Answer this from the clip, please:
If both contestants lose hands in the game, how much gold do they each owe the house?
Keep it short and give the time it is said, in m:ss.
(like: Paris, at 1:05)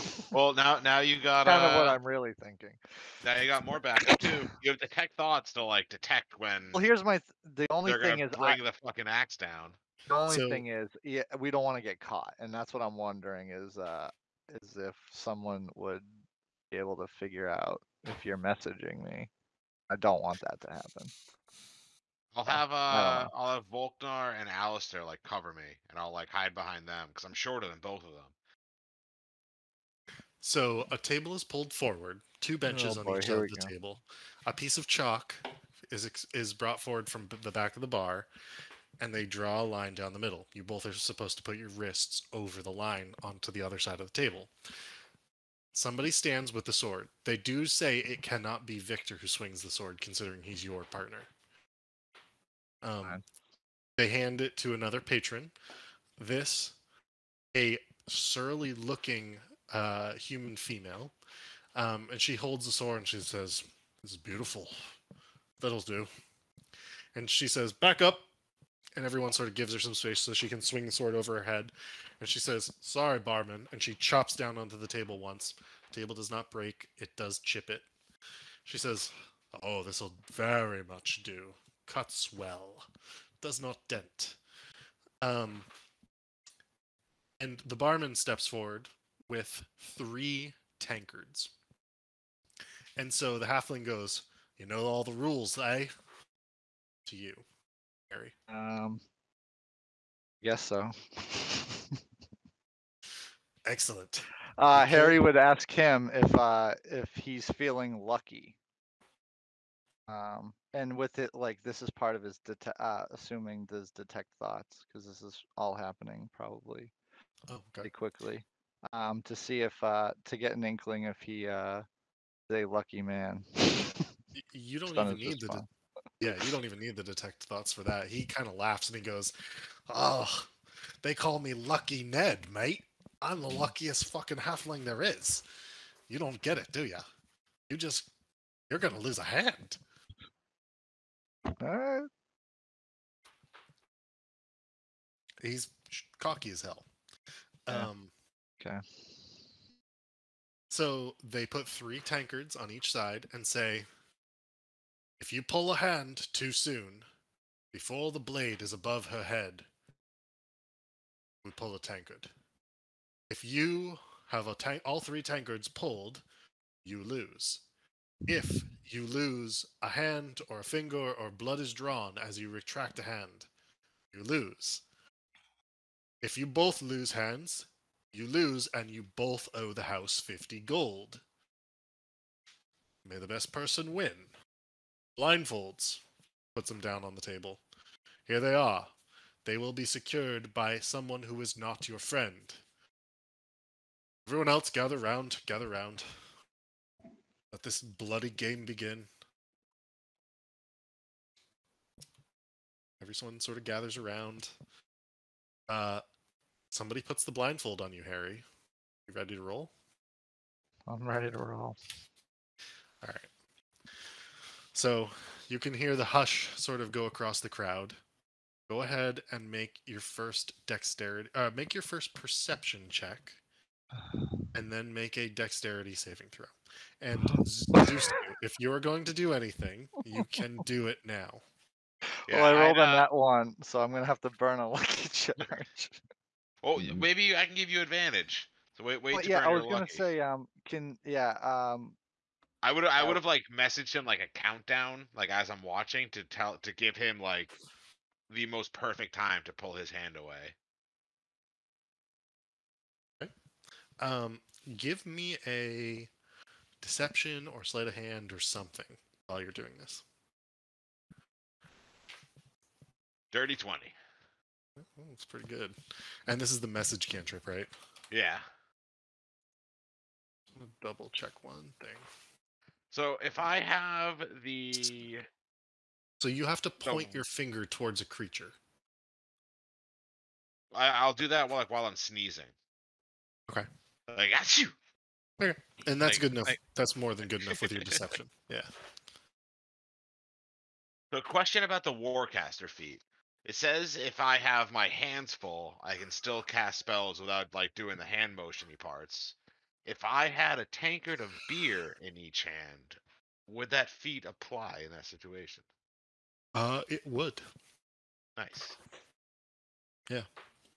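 50 gold, at 3:00.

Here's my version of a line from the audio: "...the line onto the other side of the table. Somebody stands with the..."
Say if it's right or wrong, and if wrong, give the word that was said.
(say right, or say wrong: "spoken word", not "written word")
right.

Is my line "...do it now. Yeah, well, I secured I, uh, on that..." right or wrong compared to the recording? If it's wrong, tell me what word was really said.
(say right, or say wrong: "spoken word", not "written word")
wrong: "rolled", not "secured".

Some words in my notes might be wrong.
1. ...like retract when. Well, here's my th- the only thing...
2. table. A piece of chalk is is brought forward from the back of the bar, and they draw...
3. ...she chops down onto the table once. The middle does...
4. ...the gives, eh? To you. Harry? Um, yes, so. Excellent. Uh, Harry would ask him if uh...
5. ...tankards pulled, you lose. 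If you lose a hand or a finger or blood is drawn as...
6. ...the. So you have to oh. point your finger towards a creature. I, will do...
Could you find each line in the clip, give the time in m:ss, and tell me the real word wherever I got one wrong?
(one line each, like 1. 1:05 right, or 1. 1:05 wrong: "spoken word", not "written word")
1. 0:05 wrong: "detect", not "retract"
2. 0:33 right
3. 1:13 wrong: "table", not "middle"
4. 1:35 wrong: "rules", not "gives"
5. 2:45 right
6. 4:34 right.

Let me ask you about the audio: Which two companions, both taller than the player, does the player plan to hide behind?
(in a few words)
Volknar and Alistair.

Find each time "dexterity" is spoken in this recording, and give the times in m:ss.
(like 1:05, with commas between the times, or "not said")
3:40, 3:45.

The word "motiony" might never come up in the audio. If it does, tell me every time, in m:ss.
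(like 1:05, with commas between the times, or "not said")
4:58.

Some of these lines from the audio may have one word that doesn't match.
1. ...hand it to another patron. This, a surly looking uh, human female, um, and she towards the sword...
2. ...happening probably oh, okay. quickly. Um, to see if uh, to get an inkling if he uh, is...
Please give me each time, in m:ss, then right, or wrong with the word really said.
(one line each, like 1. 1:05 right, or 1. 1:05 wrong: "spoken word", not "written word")
1. 0:54 wrong: "holds", not "towards"
2. 1:55 right.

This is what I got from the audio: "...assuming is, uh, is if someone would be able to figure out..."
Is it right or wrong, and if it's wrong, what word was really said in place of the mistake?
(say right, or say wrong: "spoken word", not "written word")
wrong: "wondering", not "assuming".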